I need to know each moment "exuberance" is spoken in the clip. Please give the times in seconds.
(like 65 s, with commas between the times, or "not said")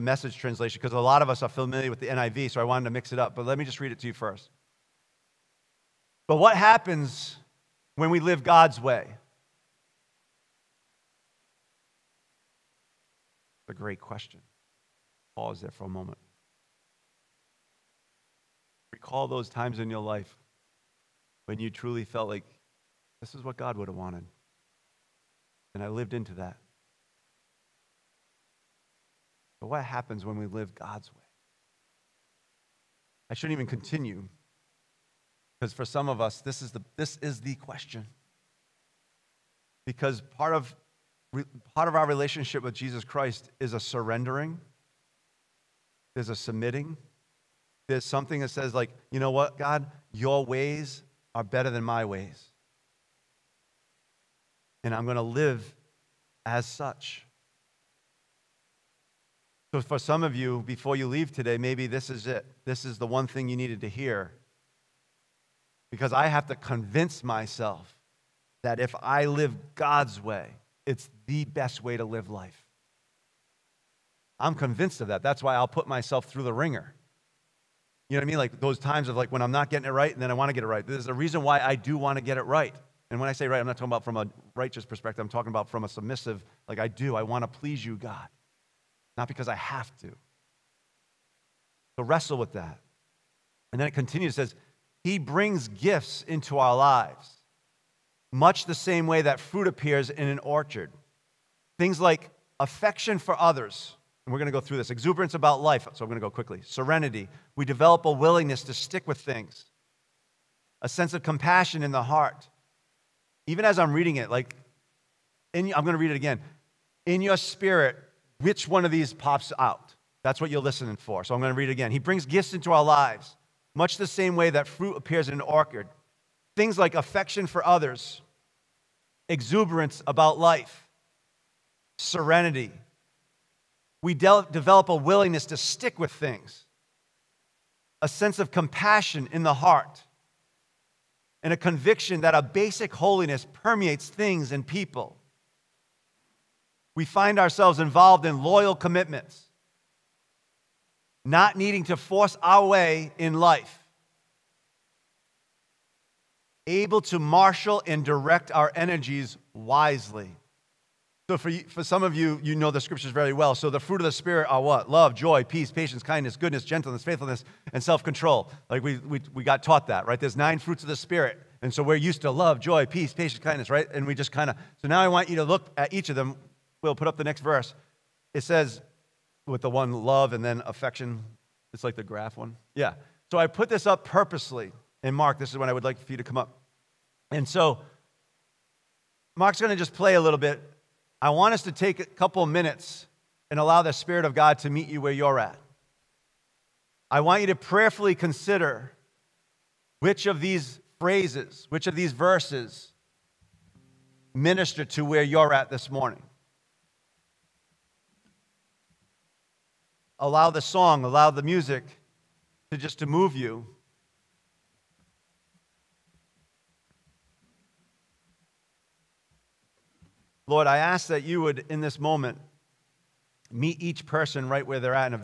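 104 s, 129 s.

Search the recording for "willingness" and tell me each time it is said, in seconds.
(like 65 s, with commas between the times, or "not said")
108 s, 134 s.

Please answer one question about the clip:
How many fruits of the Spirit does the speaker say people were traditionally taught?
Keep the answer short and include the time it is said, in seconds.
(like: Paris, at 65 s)
9, at 170 s.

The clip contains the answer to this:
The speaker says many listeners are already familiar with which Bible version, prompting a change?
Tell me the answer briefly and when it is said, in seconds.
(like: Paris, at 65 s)
NIV, at 2 s.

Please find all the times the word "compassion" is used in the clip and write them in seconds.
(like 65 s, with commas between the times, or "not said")
111 s, 138 s.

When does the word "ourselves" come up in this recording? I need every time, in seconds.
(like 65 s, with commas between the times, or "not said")
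147 s.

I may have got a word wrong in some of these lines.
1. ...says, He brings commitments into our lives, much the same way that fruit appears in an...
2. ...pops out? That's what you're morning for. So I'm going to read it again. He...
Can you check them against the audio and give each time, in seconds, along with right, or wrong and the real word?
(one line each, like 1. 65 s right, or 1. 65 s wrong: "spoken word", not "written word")
1. 94 s wrong: "gifts", not "commitments"
2. 119 s wrong: "listening", not "morning".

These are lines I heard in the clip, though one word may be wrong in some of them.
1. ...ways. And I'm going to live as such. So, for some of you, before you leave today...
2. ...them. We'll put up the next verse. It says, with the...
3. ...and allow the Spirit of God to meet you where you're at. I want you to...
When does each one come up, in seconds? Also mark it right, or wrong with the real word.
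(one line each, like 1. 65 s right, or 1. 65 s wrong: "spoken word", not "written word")
1. 52 s right
2. 176 s right
3. 193 s right.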